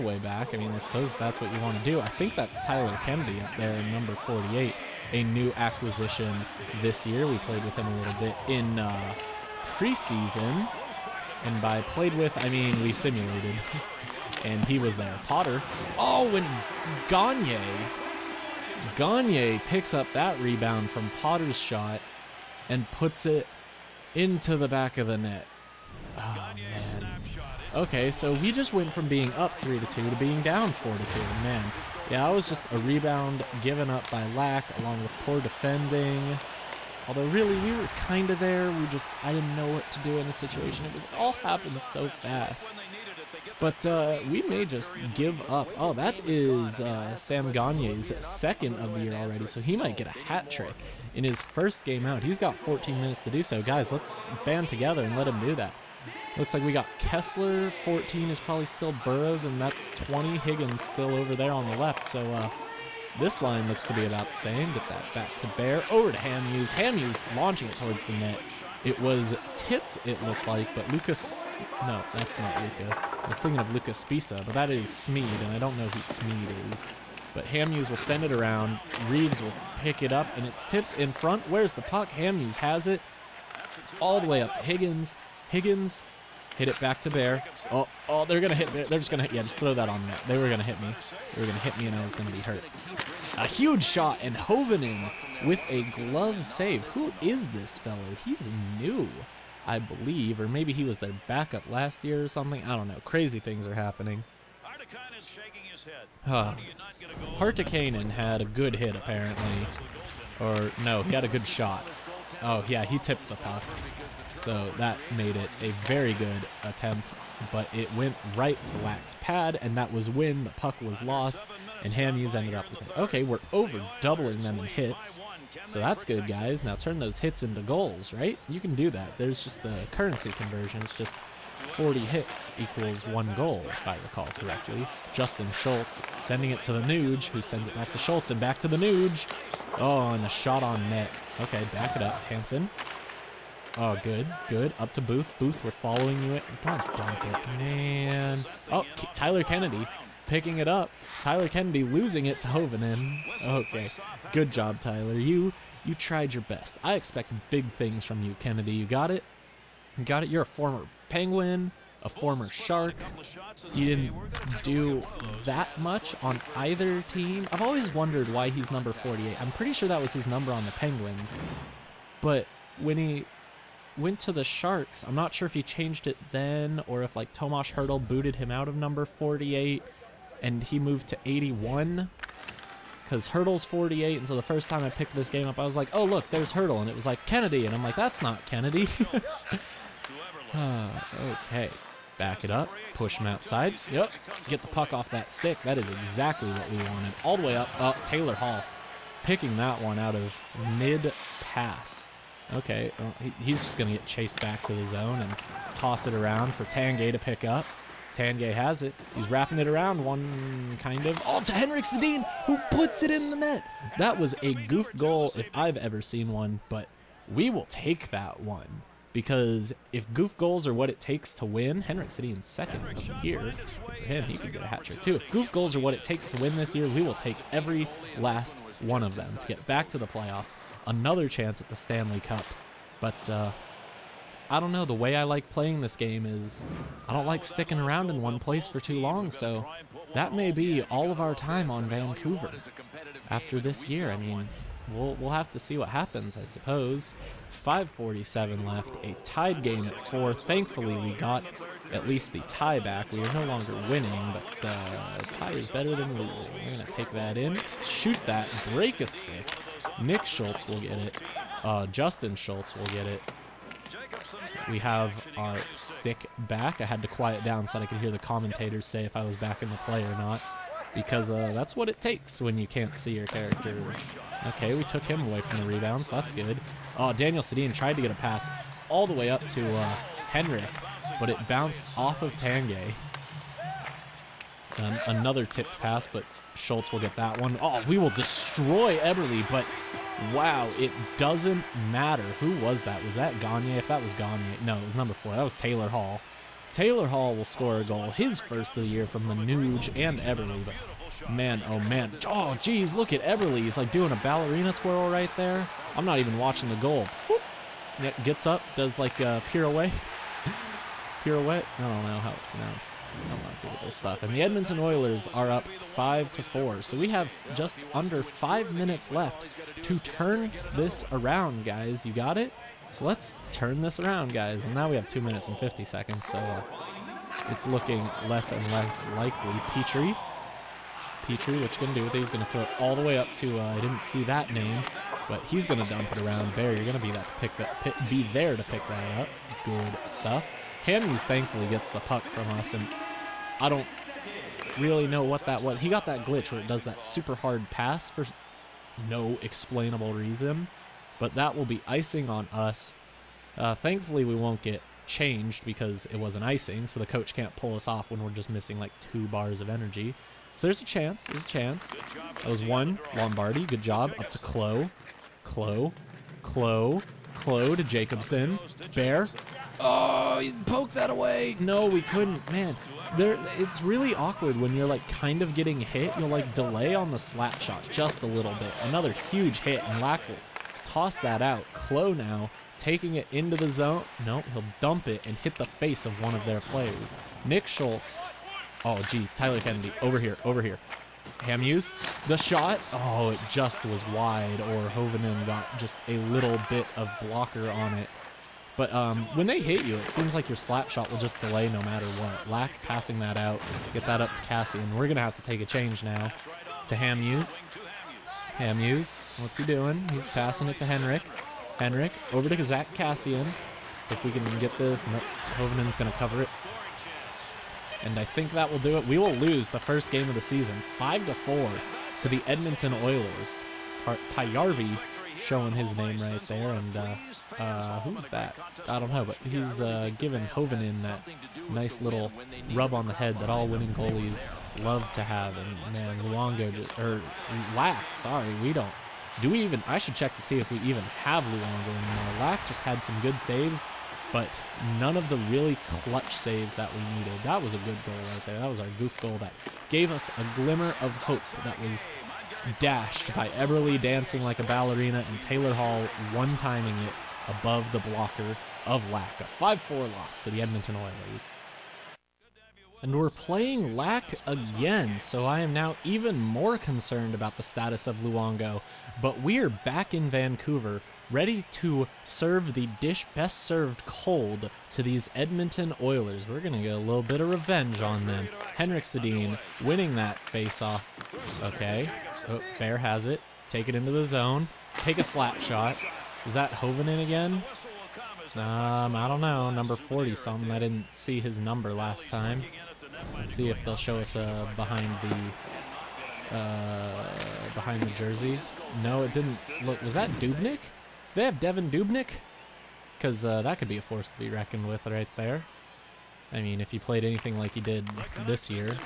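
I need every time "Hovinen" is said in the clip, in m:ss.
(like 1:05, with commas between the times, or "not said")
1:34, 2:32, 7:10.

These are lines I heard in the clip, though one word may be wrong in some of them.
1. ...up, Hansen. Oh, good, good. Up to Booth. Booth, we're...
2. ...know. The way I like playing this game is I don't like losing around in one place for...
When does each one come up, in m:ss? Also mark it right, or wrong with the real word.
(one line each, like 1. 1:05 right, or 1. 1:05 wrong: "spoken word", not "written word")
1. 2:22 right
2. 3:54 wrong: "sticking", not "losing".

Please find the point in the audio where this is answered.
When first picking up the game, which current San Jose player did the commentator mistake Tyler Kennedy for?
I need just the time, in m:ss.
2:57.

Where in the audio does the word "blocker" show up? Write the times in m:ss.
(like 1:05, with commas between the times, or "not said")
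6:37, 7:38.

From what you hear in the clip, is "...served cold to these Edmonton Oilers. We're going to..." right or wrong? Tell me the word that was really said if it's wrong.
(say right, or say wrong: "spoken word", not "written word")
right.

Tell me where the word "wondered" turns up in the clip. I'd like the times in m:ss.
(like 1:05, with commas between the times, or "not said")
2:47.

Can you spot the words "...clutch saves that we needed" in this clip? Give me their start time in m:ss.
7:25.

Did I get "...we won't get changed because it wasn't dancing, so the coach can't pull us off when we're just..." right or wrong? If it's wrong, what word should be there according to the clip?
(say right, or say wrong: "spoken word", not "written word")
wrong: "icing", not "dancing".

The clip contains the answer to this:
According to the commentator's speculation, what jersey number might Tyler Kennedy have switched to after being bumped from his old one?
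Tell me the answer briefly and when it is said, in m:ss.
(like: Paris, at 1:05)
81, at 3:01.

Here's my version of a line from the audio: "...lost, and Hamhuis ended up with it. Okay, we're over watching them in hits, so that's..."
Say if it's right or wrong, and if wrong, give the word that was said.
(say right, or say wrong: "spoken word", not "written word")
wrong: "doubling", not "watching".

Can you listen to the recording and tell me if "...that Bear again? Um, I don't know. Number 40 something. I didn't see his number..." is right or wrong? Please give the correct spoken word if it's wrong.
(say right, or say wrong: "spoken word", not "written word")
wrong: "Hovenin", not "Bear".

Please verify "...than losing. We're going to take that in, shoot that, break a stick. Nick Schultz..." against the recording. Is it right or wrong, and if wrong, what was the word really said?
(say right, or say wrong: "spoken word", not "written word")
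right.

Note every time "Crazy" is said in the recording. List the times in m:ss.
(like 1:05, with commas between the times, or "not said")
1:43.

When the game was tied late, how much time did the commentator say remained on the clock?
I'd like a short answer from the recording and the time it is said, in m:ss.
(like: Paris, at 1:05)
5:47, at 4:07.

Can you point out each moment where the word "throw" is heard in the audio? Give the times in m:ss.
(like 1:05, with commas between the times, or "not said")
1:29, 5:32.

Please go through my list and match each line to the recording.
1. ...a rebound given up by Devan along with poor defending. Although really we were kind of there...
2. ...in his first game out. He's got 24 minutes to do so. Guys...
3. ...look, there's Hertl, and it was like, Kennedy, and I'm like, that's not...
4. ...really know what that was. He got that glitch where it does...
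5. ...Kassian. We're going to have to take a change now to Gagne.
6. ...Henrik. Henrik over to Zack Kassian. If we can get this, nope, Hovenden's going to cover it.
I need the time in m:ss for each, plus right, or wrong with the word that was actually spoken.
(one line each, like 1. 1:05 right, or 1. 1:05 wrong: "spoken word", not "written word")
1. 0:32 wrong: "Lack", not "Devan"
2. 0:51 wrong: "14", not "24"
3. 3:06 right
4. 5:44 right
5. 6:44 wrong: "Hamhuis", not "Gagne"
6. 6:50 right.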